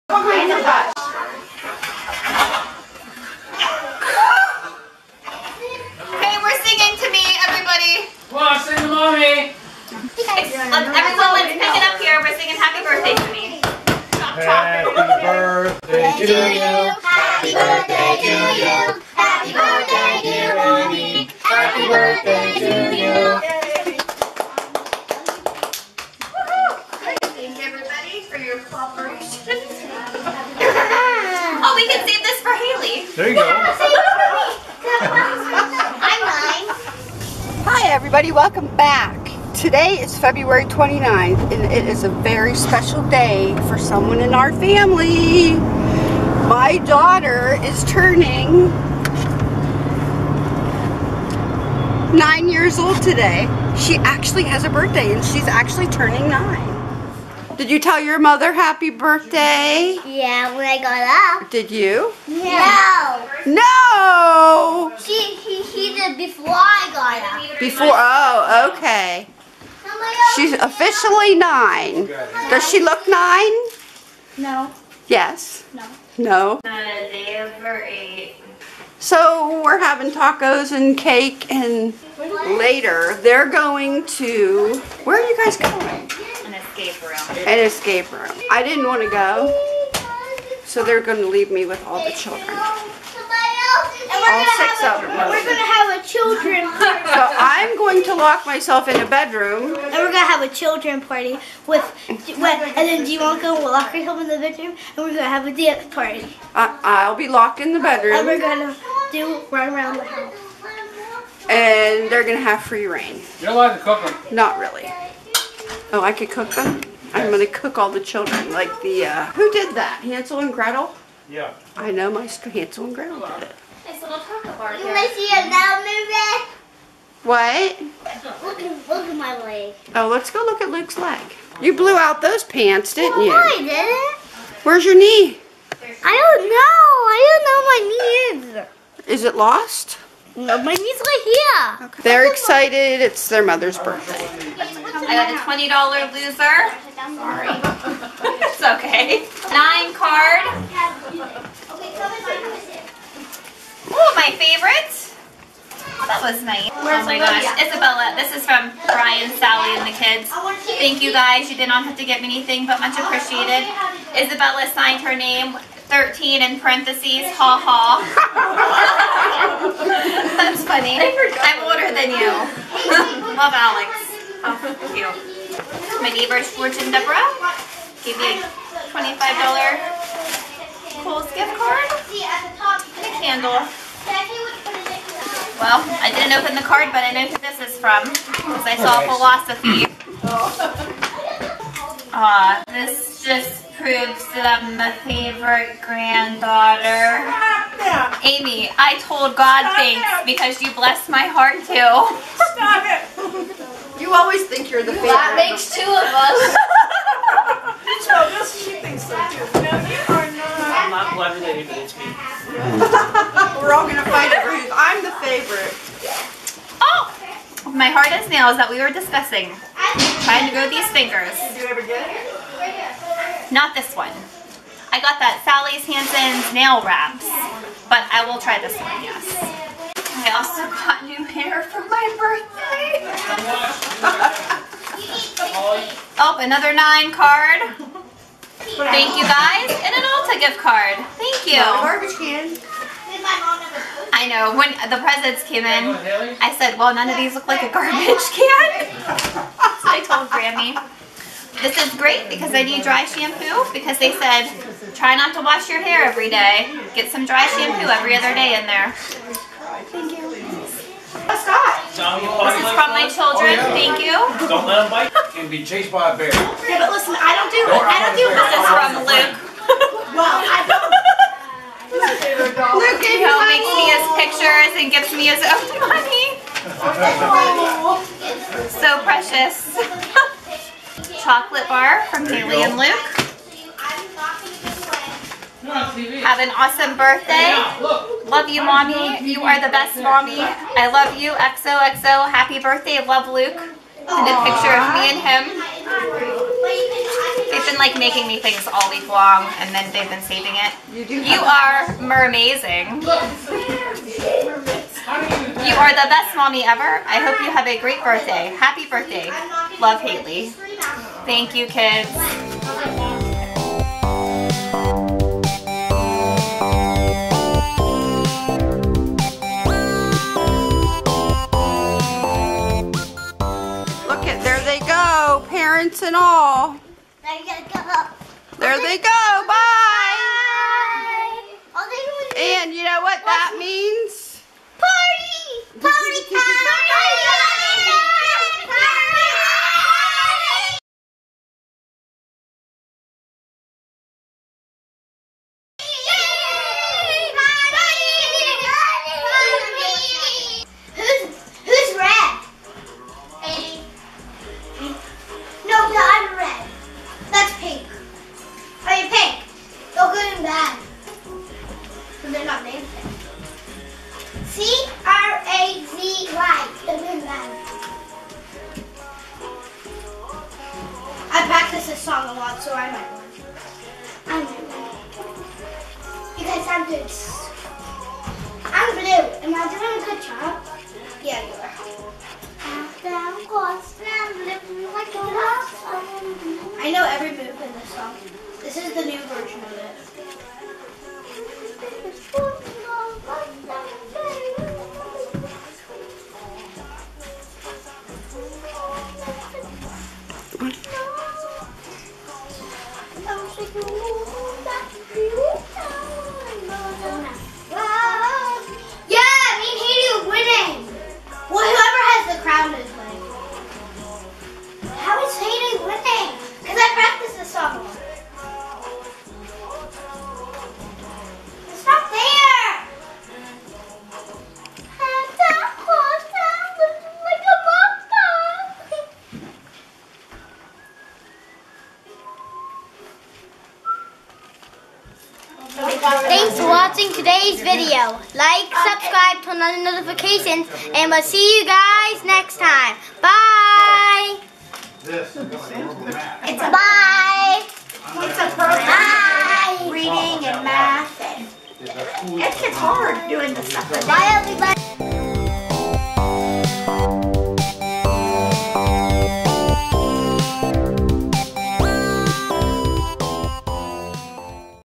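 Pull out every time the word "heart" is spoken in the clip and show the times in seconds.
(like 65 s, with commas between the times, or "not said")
201 s, 217 s.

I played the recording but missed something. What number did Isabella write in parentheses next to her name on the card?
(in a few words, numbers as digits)
13.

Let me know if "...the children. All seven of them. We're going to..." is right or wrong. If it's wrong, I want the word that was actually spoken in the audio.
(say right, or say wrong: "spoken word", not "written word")
wrong: "six", not "seven".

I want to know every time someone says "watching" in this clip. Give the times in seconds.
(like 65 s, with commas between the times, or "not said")
436 s.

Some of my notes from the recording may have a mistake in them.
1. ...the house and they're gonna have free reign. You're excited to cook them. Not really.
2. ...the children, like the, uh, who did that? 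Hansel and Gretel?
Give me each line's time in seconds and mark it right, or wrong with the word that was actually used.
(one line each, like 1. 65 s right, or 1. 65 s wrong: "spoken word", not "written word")
1. 109 s wrong: "allowed", not "excited"
2. 117 s right.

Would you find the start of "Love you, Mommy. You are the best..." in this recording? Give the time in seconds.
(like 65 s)
288 s.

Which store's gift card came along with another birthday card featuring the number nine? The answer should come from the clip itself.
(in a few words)
Ulta.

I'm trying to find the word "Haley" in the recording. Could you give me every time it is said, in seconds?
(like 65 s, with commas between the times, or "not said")
32 s, 282 s, 309 s.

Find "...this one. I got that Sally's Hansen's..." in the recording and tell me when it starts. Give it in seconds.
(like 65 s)
223 s.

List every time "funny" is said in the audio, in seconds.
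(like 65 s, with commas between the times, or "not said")
170 s.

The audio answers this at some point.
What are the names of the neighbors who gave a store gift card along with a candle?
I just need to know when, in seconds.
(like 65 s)
176 s.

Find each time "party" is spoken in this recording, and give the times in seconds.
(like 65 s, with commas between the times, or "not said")
96 s, 101 s, 105 s.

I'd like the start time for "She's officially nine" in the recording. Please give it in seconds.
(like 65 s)
70 s.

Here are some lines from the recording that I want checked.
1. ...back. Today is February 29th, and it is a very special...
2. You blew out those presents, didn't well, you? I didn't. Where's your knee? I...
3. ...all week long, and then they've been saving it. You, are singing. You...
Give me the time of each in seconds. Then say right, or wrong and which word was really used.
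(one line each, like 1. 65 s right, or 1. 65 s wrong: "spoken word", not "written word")
1. 38 s right
2. 131 s wrong: "pants", not "presents"
3. 298 s wrong: "mermazing", not "singing".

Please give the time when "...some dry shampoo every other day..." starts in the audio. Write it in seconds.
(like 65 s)
257 s.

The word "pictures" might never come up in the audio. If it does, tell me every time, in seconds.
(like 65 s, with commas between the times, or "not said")
274 s, 294 s.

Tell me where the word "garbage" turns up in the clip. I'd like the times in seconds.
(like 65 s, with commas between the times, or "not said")
241 s, 247 s.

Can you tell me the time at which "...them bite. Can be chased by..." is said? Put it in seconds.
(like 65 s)
264 s.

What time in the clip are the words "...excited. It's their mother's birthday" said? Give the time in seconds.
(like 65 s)
142 s.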